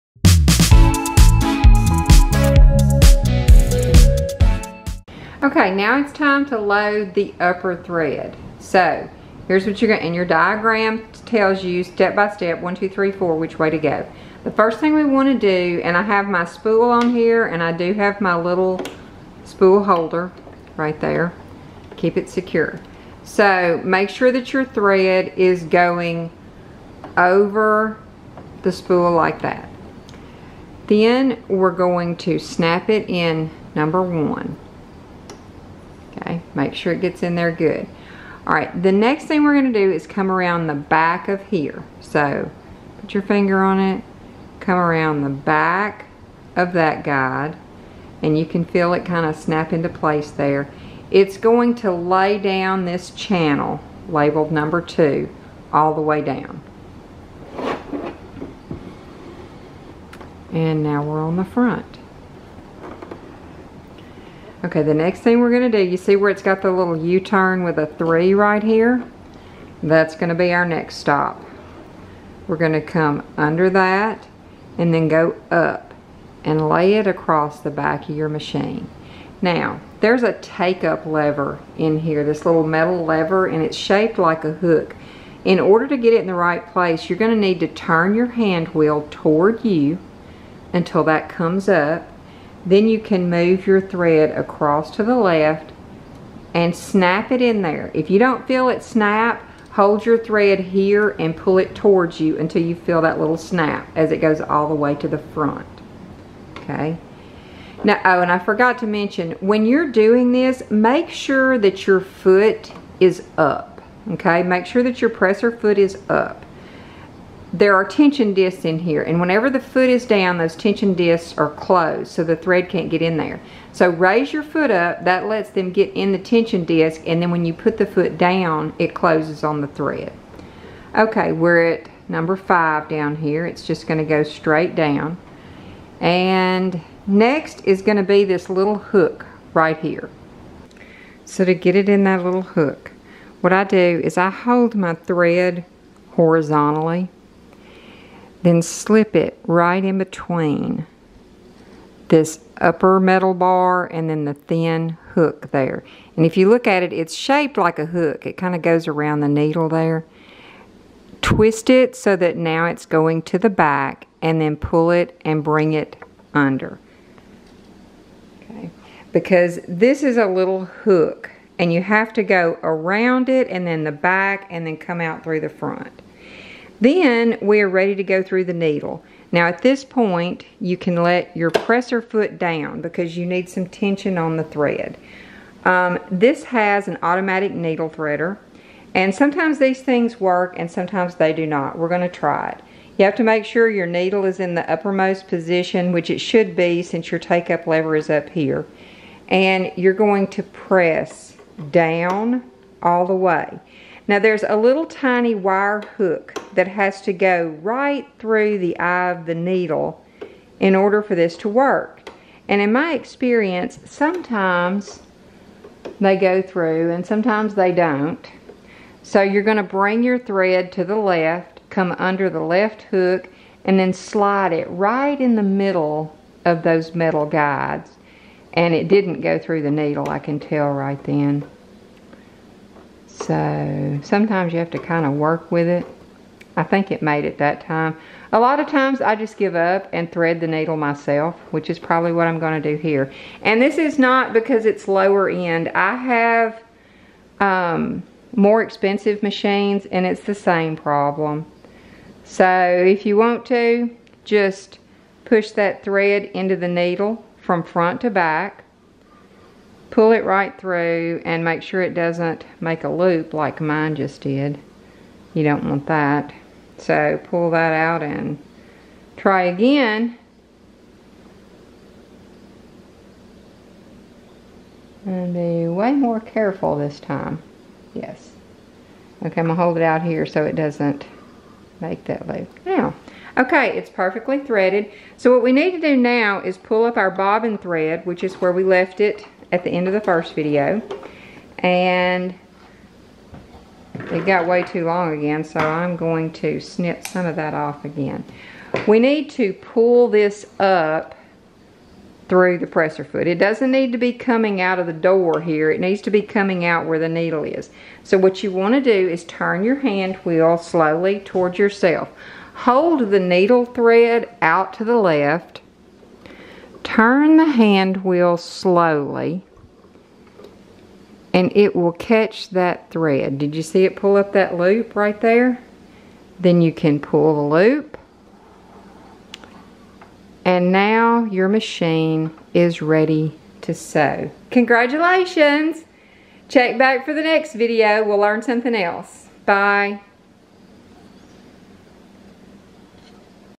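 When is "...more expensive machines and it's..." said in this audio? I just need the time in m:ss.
4:08.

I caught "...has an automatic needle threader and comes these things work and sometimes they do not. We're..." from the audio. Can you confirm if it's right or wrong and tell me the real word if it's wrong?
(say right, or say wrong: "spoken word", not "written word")
wrong: "sometimes", not "comes".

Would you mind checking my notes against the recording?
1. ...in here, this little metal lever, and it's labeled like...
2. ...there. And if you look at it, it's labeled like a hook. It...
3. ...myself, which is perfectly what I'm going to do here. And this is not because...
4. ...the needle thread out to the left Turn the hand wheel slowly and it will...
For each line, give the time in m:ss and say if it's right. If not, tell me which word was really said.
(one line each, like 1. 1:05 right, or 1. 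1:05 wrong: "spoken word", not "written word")
1. 1:21 wrong: "shaped", not "labeled"
2. 2:35 wrong: "shaped", not "labeled"
3. 4:00 wrong: "probably", not "perfectly"
4. 5:13 right.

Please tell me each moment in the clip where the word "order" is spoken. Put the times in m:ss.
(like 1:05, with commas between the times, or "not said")
1:25, 3:30.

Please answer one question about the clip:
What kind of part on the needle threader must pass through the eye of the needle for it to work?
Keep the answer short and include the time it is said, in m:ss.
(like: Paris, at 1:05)
tiny wire hook, at 3:24.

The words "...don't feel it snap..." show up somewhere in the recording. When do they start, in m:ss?
1:38.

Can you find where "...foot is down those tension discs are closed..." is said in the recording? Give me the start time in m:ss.
1:59.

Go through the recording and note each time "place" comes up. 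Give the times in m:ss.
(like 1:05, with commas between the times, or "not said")
0:49, 1:26.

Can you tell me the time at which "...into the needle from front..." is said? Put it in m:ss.
4:16.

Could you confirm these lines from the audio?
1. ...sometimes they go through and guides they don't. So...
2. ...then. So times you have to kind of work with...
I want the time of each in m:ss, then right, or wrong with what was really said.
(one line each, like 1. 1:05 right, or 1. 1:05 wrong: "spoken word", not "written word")
1. 3:33 wrong: "sometimes", not "guides"
2. 3:51 wrong: "sometimes", not "times".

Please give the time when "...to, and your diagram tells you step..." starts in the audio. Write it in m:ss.
0:10.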